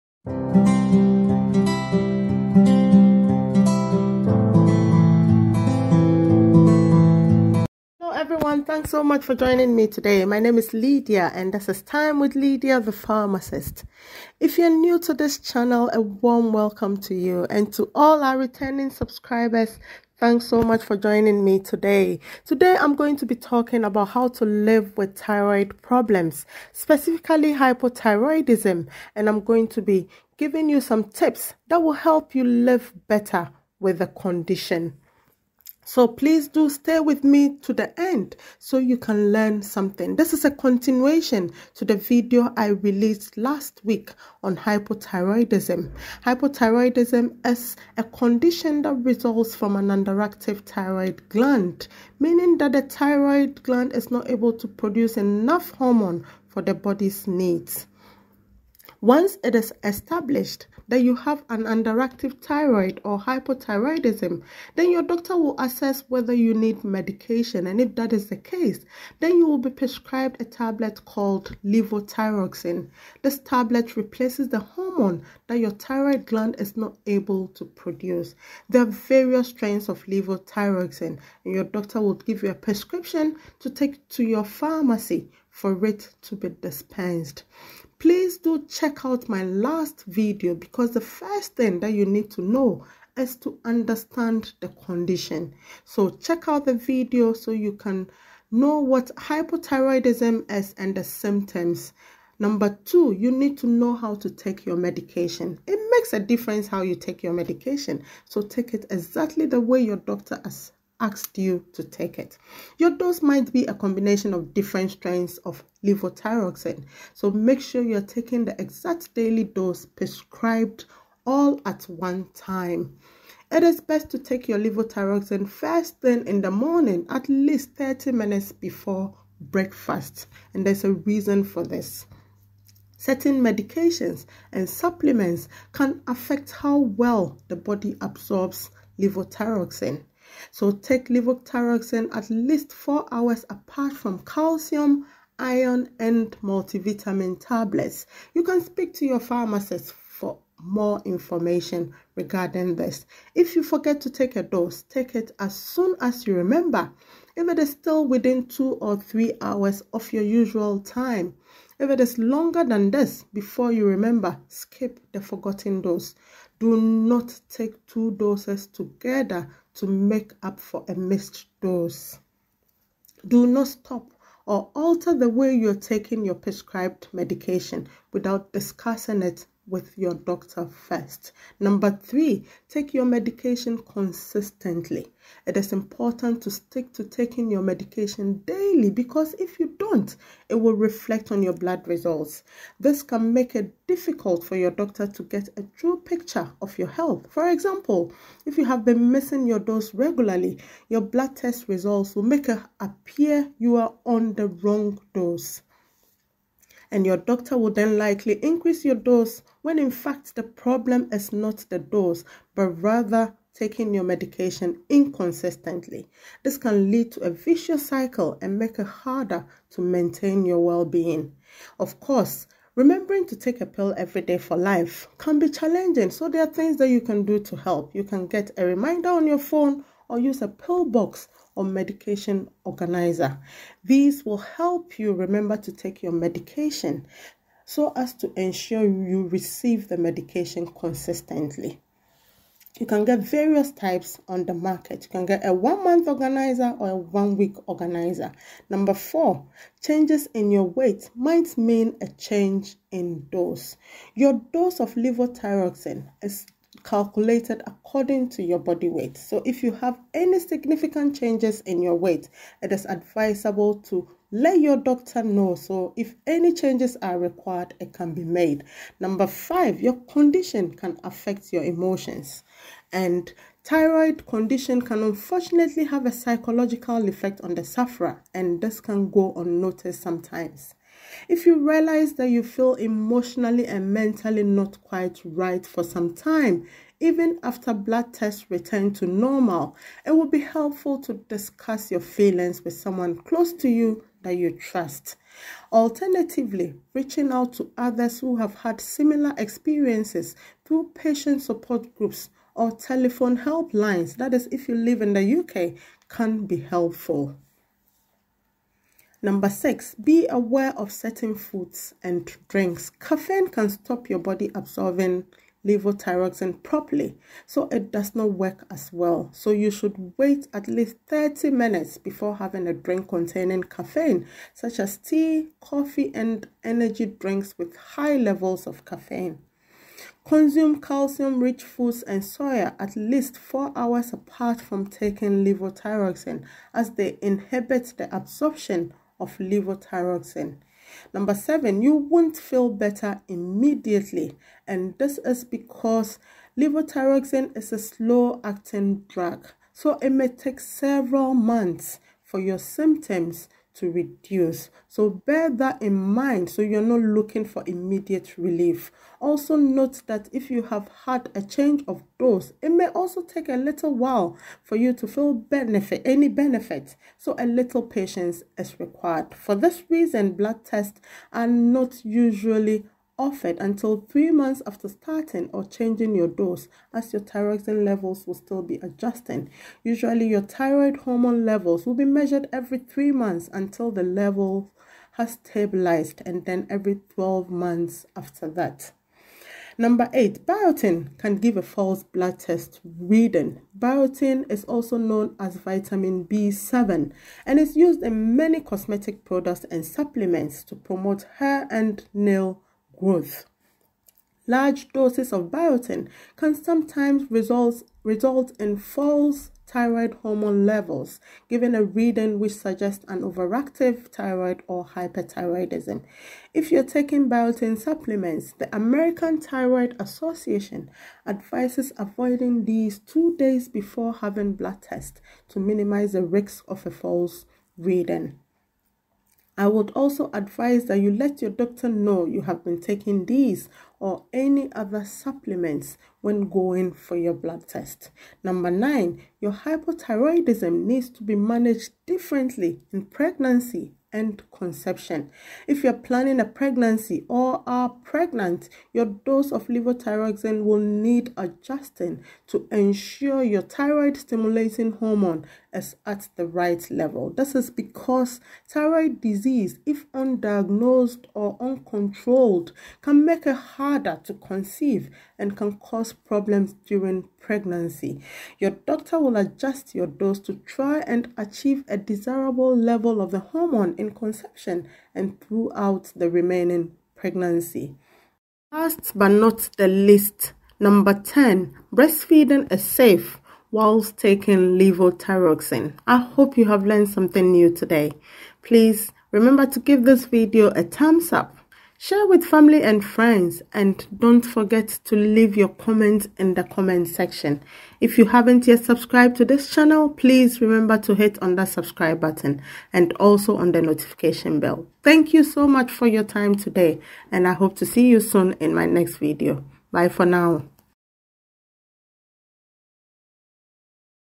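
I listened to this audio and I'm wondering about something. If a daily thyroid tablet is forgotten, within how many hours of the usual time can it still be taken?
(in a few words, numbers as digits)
2 or 3 hours.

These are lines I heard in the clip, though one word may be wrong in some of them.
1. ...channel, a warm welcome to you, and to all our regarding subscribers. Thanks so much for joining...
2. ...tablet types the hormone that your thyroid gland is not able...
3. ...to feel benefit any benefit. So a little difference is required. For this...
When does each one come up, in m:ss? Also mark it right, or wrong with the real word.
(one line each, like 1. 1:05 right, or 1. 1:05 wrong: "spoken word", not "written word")
1. 0:15 wrong: "returning", not "regarding"
2. 1:13 wrong: "replaces", not "types"
3. 6:04 wrong: "patience", not "difference".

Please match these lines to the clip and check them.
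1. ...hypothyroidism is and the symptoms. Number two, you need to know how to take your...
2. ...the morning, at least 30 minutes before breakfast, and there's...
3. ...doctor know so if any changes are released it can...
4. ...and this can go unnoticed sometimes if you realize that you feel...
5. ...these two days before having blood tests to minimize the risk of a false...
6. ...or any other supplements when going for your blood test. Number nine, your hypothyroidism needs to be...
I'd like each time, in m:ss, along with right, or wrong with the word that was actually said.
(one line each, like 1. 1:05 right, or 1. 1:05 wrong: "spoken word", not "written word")
1. 1:39 right
2. 2:06 right
3. 4:24 wrong: "required", not "released"
4. 4:38 right
5. 7:02 right
6. 7:13 right.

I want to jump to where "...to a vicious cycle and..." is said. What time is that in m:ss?
3:37.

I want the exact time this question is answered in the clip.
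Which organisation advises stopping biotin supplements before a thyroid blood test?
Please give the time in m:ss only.
6:58.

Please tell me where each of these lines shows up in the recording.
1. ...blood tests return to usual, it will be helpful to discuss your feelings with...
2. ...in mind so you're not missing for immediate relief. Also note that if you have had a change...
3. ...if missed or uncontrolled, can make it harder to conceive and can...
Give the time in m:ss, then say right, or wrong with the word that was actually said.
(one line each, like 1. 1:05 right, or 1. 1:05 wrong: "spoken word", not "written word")
1. 4:47 wrong: "normal", not "usual"
2. 5:55 wrong: "looking", not "missing"
3. 7:39 wrong: "undiagnosed", not "missed".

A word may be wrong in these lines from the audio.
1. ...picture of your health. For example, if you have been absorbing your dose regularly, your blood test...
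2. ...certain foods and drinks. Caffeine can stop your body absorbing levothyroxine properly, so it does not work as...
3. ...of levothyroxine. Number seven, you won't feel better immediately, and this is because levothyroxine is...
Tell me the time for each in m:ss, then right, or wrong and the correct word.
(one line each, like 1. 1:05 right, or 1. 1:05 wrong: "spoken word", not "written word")
1. 3:16 wrong: "missing", not "absorbing"
2. 5:10 right
3. 5:39 right.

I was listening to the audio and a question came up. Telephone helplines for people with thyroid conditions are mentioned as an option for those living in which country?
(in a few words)
UK.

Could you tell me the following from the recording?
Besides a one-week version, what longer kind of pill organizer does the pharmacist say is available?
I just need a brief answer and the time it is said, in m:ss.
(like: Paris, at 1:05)
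one month organizer, at 4:05.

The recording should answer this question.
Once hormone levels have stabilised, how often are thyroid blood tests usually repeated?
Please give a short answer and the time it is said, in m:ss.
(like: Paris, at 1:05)
every 12 months, at 6:26.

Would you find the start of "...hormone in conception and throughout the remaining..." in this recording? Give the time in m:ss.
7:53.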